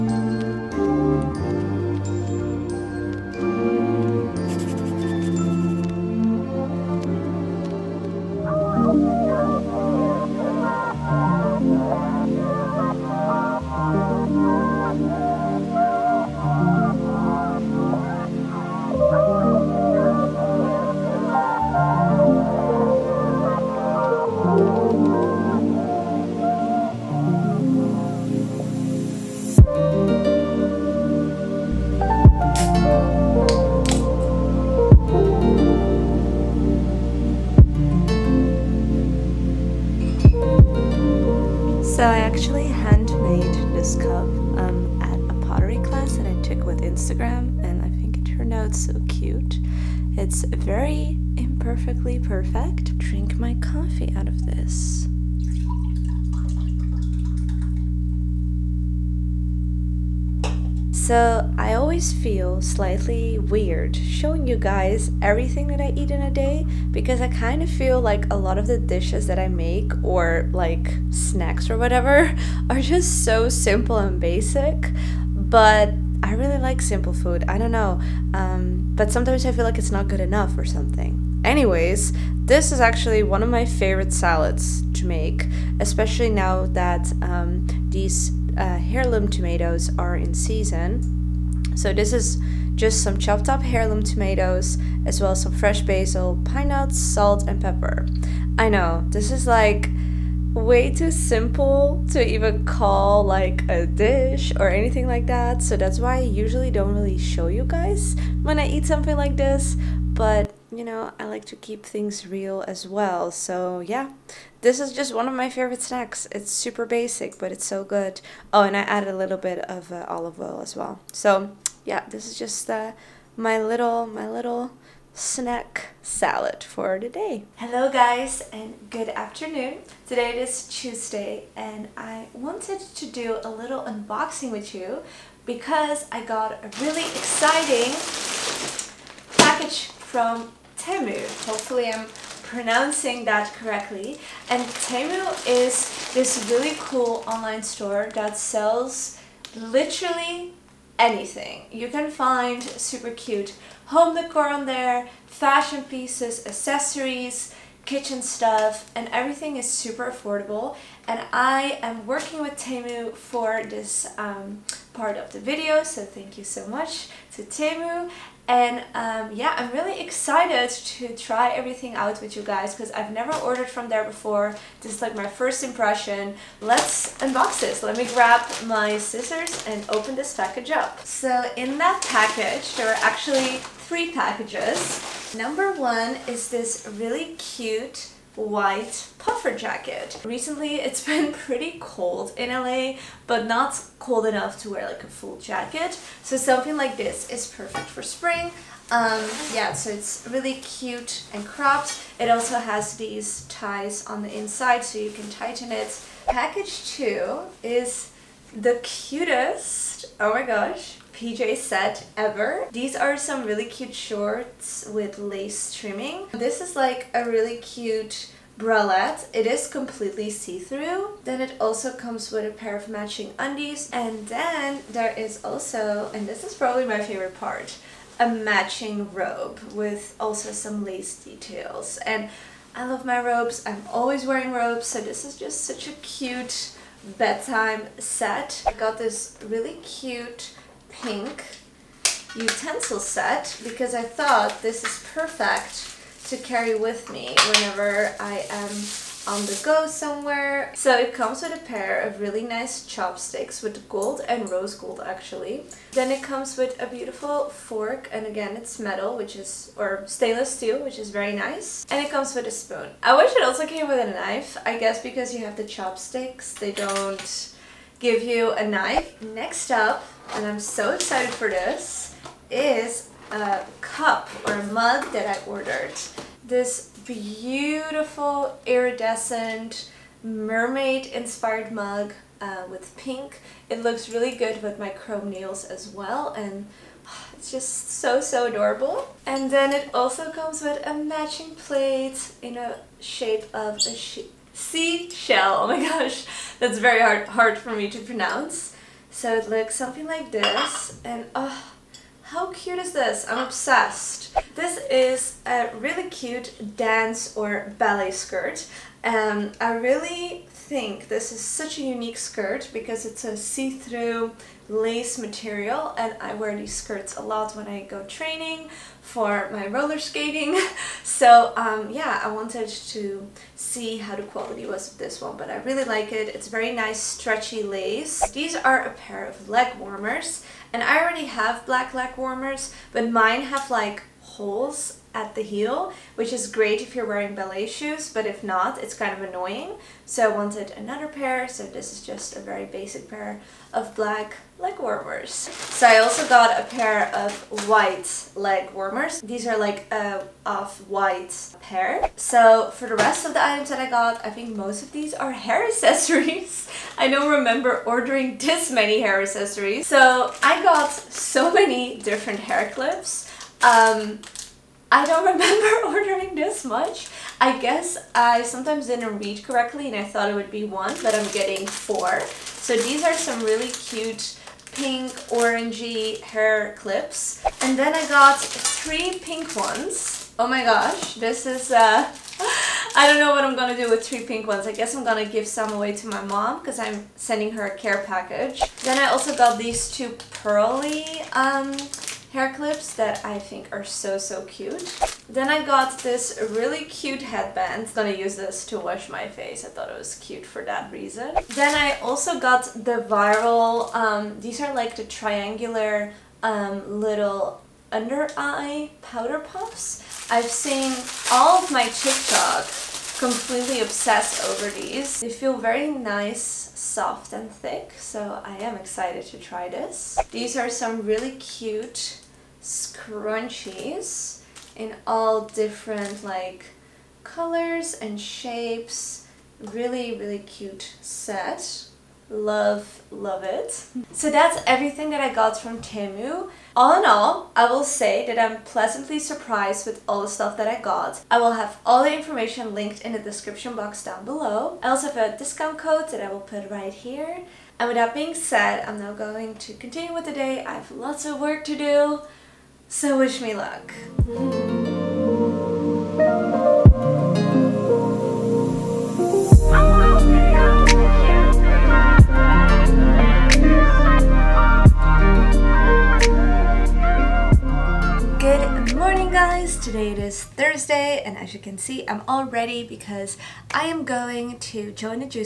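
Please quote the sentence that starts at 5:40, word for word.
So I wanted another pair, so this is just a very basic pair of black leg warmers.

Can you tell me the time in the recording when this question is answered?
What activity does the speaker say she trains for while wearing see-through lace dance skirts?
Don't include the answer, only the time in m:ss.
5:19.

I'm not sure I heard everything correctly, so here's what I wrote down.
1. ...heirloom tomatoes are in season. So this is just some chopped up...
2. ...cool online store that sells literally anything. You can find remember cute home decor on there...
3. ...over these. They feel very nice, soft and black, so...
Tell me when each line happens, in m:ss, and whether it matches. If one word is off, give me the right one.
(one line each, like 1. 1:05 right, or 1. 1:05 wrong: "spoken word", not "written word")
1. 1:28 right
2. 2:26 wrong: "super", not "remember"
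3. 6:54 wrong: "thick", not "black".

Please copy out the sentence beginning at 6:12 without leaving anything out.
So these are some really cute pink orangey hair clips.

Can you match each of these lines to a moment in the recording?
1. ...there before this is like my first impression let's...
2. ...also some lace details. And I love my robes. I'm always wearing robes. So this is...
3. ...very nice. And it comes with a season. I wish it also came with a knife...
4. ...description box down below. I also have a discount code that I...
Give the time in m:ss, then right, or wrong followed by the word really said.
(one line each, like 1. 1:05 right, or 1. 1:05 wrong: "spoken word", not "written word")
1. 2:53 right
2. 3:50 right
3. 4:21 wrong: "spoon", not "season"
4. 7:23 right.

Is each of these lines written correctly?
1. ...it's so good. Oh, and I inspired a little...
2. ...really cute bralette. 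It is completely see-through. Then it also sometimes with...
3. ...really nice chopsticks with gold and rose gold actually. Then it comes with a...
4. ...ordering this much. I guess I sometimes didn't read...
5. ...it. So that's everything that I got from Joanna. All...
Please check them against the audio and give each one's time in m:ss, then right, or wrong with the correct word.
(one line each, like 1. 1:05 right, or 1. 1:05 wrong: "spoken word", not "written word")
1. 1:57 wrong: "added", not "inspired"
2. 3:37 wrong: "comes", not "sometimes"
3. 4:12 right
4. 6:05 right
5. 7:13 wrong: "Temu", not "Joanna".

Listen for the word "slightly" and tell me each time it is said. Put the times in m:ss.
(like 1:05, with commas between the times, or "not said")
1:02.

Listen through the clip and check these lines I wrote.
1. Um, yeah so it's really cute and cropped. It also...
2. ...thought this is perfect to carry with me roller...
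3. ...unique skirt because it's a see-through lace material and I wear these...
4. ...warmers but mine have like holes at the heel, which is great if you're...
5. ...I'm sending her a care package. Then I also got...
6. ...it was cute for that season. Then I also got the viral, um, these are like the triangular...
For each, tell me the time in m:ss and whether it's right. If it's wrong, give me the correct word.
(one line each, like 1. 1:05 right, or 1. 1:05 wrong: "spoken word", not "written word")
1. 3:18 right
2. 4:04 wrong: "whenever", not "roller"
3. 5:11 right
4. 5:32 right
5. 6:26 right
6. 6:39 wrong: "reason", not "season".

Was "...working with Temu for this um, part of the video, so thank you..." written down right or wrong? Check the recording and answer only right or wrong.
right.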